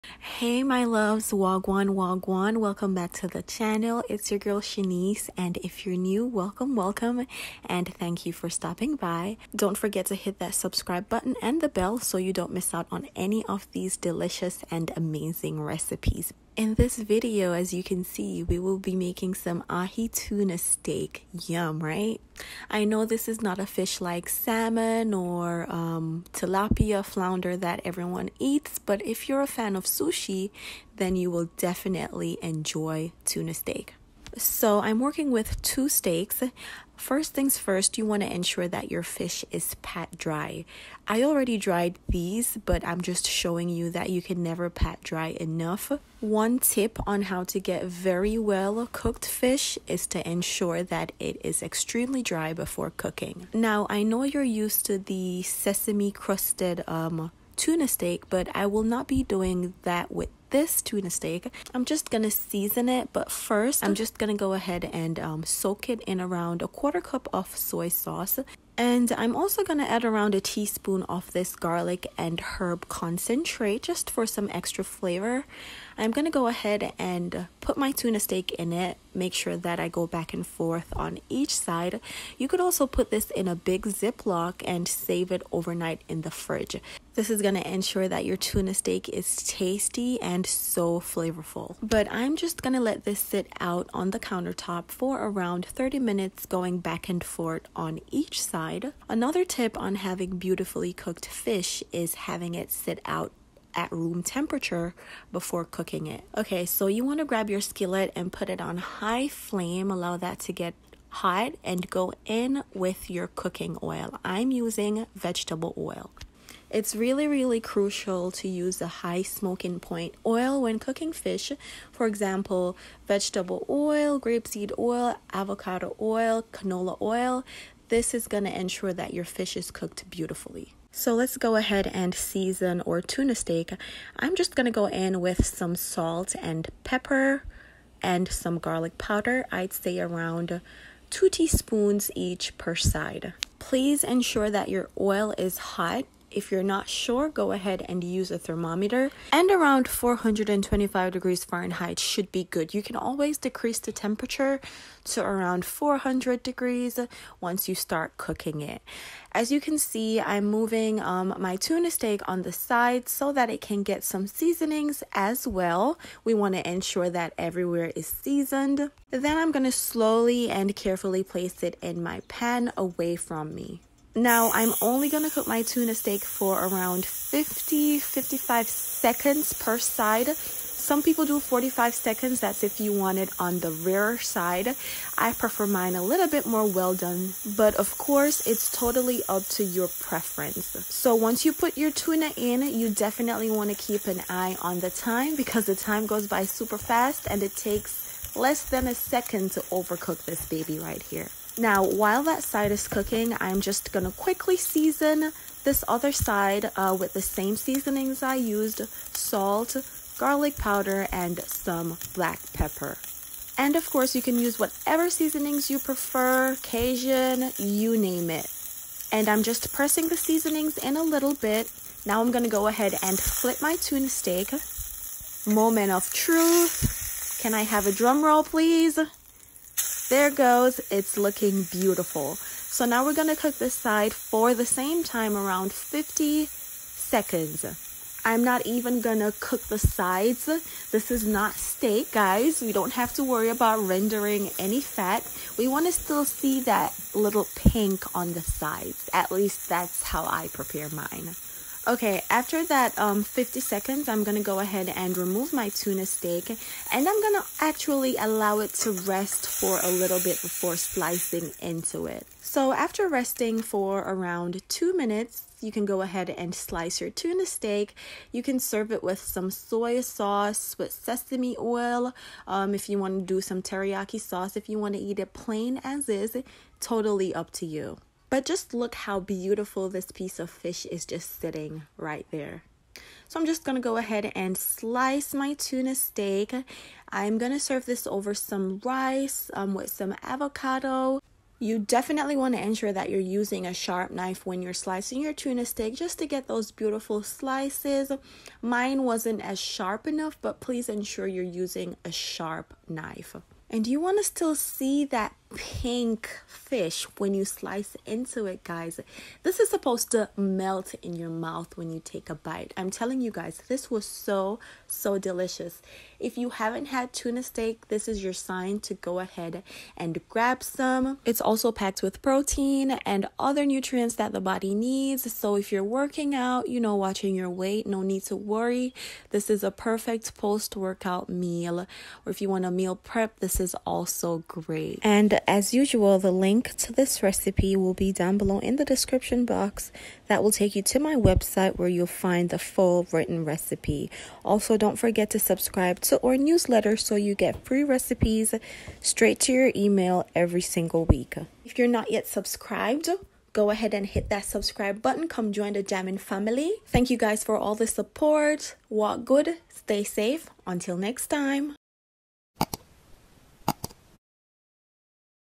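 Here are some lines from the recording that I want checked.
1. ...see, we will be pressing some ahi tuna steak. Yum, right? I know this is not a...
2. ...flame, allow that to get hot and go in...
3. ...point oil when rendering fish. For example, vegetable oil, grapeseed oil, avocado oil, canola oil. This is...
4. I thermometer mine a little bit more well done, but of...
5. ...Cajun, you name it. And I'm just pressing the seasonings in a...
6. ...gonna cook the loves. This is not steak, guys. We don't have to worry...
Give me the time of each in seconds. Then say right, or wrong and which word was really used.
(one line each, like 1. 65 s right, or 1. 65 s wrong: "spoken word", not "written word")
1. 18 s wrong: "making", not "pressing"
2. 109 s right
3. 119 s wrong: "cooking", not "rendering"
4. 185 s wrong: "prefer", not "thermometer"
5. 216 s right
6. 238 s wrong: "sides", not "loves".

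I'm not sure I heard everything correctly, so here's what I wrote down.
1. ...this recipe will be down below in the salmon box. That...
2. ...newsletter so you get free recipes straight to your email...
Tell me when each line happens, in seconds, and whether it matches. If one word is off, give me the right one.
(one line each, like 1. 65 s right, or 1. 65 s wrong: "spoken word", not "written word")
1. 336 s wrong: "description", not "salmon"
2. 346 s right.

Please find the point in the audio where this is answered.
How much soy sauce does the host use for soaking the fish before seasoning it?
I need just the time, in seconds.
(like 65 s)
66 s.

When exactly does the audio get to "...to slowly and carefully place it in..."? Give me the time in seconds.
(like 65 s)
169 s.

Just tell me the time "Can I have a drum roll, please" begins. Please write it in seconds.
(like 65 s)
227 s.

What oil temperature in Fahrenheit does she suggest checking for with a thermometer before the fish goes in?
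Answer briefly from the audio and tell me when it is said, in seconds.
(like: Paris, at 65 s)
425 degrees, at 149 s.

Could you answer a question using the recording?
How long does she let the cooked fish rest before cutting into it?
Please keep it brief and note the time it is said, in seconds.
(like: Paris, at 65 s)
2 minutes, at 264 s.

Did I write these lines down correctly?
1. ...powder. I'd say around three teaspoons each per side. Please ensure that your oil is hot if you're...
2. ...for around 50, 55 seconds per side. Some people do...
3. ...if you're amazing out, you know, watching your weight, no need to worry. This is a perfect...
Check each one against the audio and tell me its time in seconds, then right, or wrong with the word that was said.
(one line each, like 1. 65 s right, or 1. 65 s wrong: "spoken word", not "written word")
1. 138 s wrong: "two", not "three"
2. 176 s right
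3. 325 s wrong: "working", not "amazing".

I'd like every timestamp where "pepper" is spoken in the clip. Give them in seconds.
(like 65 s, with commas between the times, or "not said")
136 s, 212 s.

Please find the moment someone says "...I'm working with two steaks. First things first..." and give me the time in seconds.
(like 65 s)
34 s.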